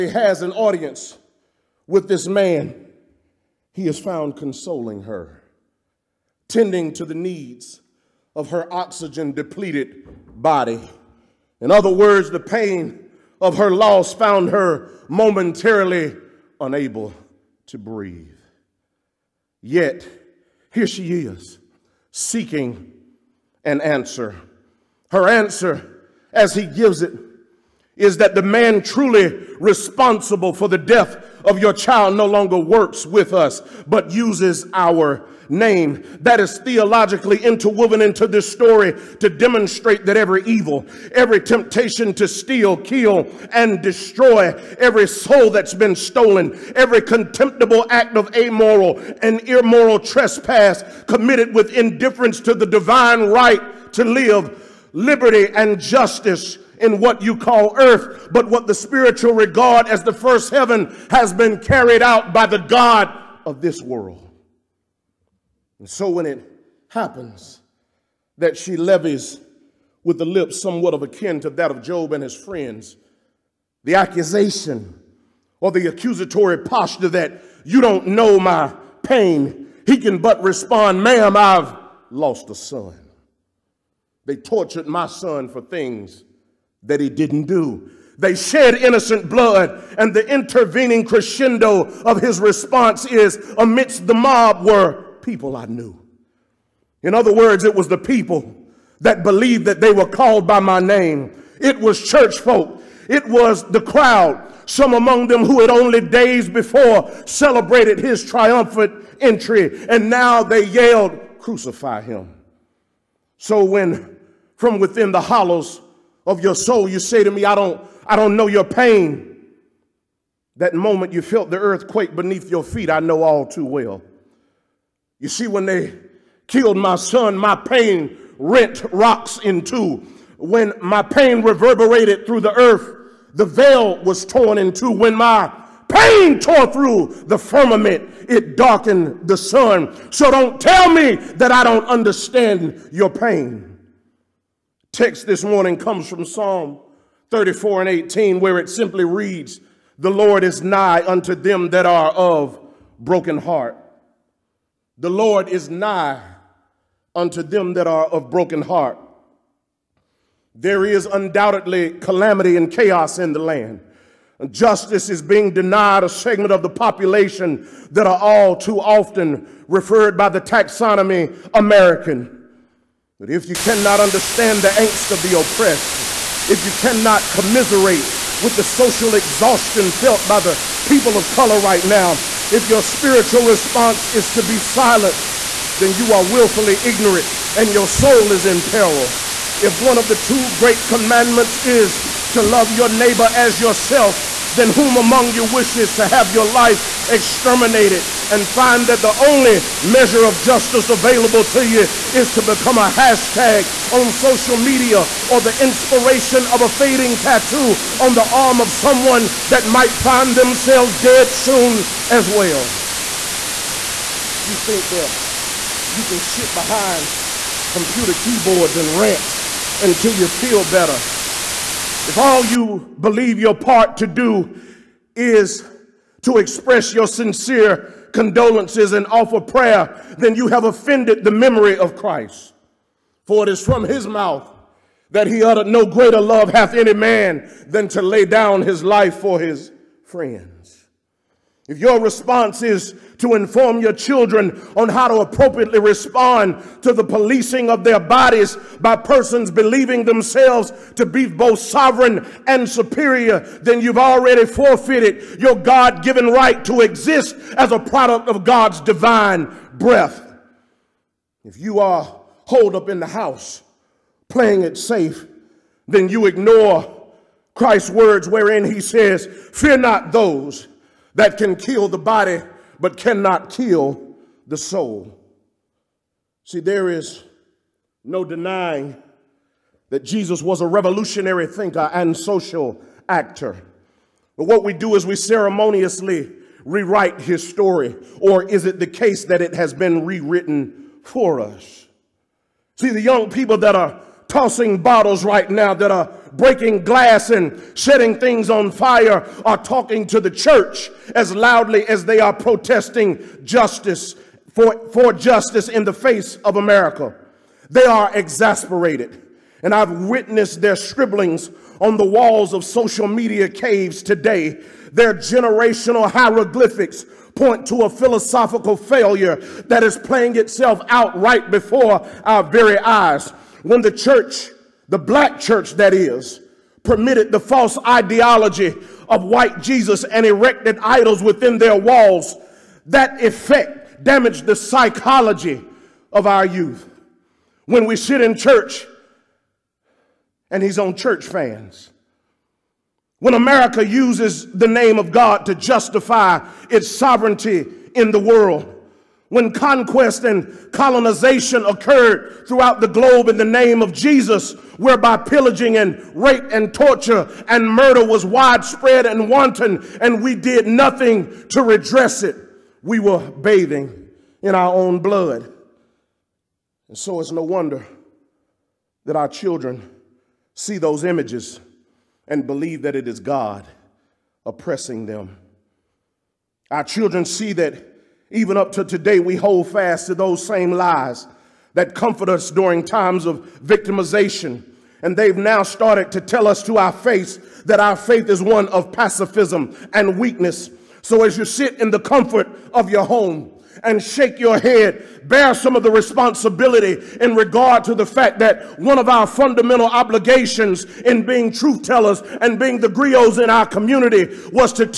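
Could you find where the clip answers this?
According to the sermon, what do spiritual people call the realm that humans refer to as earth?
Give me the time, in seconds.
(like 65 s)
60 s.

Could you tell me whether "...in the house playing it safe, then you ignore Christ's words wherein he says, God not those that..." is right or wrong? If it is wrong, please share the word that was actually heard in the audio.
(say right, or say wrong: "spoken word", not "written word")
wrong: "Fear", not "God".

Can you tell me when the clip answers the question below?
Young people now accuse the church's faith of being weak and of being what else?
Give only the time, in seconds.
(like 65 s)
388 s.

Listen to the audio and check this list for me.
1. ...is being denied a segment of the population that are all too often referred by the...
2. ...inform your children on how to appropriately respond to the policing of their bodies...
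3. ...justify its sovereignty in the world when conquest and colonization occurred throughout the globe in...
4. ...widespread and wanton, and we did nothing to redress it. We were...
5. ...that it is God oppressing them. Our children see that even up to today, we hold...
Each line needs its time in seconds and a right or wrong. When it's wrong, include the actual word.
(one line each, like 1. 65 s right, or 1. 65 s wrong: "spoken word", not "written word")
1. 165 s right
2. 243 s right
3. 345 s right
4. 358 s right
5. 372 s right.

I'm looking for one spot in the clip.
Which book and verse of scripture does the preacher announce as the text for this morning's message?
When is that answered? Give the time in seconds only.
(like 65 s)
146 s.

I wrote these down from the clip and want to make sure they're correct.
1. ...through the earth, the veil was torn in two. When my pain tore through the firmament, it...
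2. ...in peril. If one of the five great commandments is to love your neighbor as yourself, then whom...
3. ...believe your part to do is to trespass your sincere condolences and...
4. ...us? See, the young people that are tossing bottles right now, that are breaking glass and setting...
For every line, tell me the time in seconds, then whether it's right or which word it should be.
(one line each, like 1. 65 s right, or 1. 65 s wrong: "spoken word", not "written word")
1. 132 s right
2. 188 s wrong: "two", not "five"
3. 222 s wrong: "express", not "trespass"
4. 291 s right.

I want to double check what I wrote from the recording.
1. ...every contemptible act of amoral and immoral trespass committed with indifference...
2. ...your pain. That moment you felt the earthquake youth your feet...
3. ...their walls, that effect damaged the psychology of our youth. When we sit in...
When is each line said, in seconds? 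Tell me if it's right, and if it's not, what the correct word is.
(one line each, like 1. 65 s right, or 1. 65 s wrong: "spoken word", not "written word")
1. 46 s right
2. 118 s wrong: "beneath", not "youth"
3. 331 s right.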